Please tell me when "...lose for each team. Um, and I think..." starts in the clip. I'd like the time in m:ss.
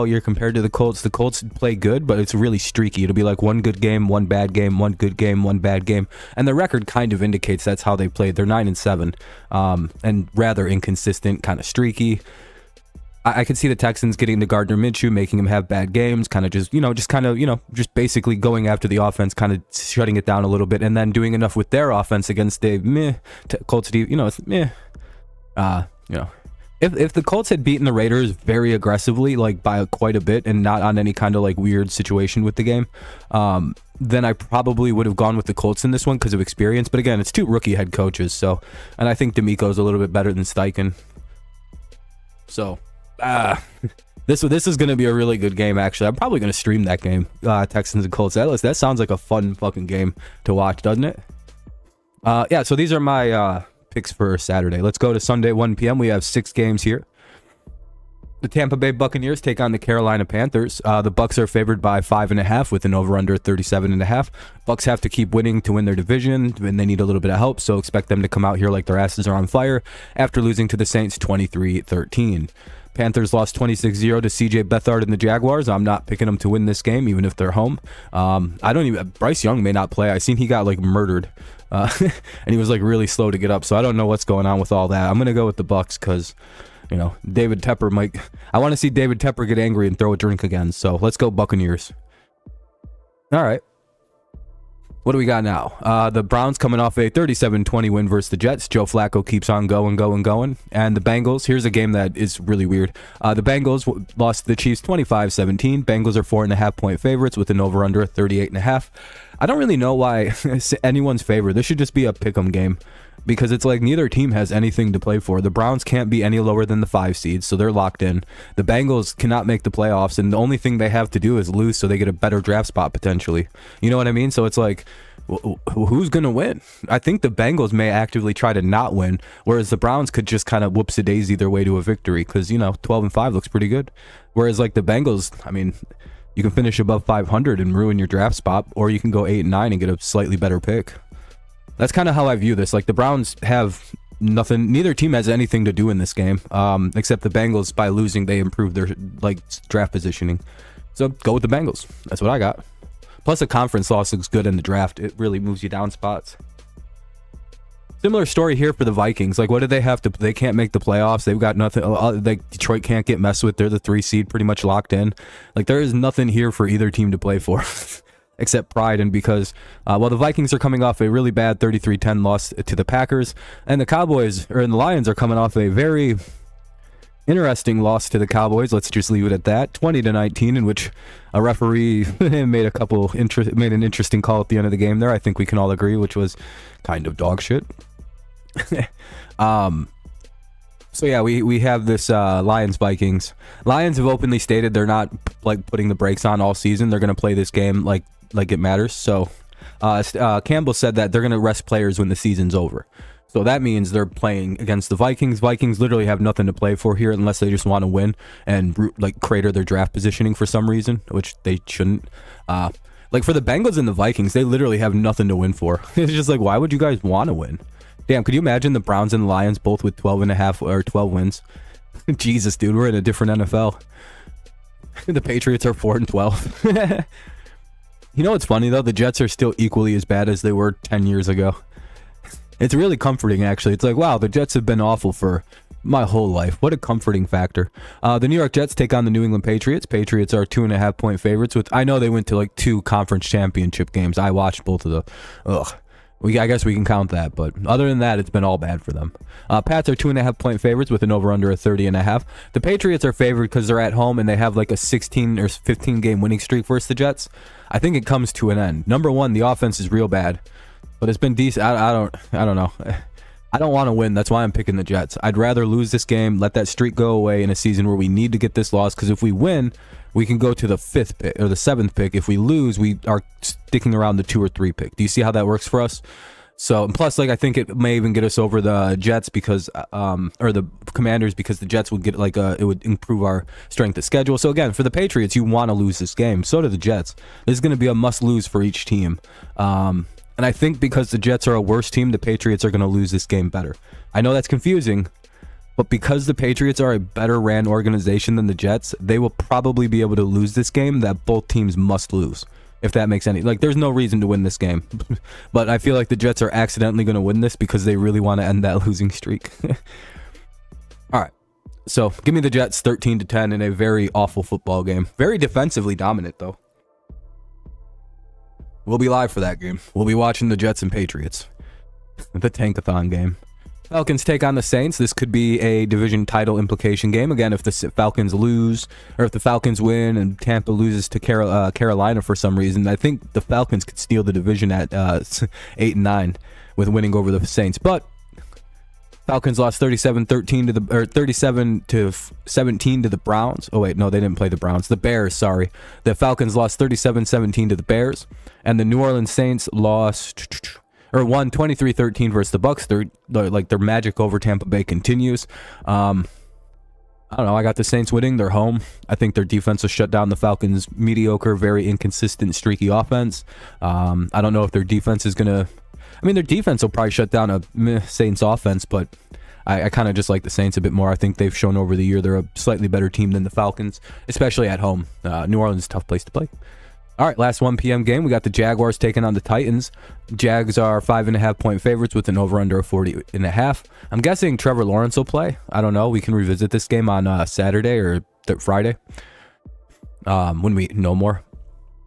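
4:48.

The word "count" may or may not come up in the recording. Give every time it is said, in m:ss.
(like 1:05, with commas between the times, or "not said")
4:06.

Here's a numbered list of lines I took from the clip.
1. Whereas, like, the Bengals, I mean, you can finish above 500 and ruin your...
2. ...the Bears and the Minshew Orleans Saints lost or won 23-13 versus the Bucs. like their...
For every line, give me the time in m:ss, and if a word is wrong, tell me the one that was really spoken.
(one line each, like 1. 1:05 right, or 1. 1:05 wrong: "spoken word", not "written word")
1. 2:14 right
2. 5:47 wrong: "New", not "Minshew".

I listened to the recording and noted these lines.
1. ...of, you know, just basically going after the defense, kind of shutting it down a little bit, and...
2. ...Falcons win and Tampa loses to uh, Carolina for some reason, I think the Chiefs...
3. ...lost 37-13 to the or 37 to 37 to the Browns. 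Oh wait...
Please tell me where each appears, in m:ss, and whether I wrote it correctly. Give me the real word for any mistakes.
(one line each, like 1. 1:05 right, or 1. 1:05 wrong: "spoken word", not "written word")
1. 0:17 wrong: "offense", not "defense"
2. 5:29 wrong: "Falcons", not "Chiefs"
3. 5:39 wrong: "17", not "37".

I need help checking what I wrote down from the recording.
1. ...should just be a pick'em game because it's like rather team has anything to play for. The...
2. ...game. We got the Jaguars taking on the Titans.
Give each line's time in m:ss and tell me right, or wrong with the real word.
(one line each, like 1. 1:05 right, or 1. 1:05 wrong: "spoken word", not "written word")
1. 1:51 wrong: "neither", not "rather"
2. 6:18 right.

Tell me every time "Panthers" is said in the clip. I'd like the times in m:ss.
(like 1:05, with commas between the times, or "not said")
1:00, 1:12.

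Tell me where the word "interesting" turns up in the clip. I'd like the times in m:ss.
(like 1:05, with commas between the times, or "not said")
2:57, 3:03.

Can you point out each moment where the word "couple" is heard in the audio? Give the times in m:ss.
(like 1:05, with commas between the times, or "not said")
3:02.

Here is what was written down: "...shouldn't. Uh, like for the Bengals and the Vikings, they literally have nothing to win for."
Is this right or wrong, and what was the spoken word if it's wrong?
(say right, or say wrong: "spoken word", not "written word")
right.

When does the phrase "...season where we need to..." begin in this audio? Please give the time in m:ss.
4:27.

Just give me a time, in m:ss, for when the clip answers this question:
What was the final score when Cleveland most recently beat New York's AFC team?
1:37.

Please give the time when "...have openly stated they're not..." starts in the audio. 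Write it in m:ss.
3:13.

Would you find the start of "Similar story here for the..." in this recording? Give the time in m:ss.
2:38.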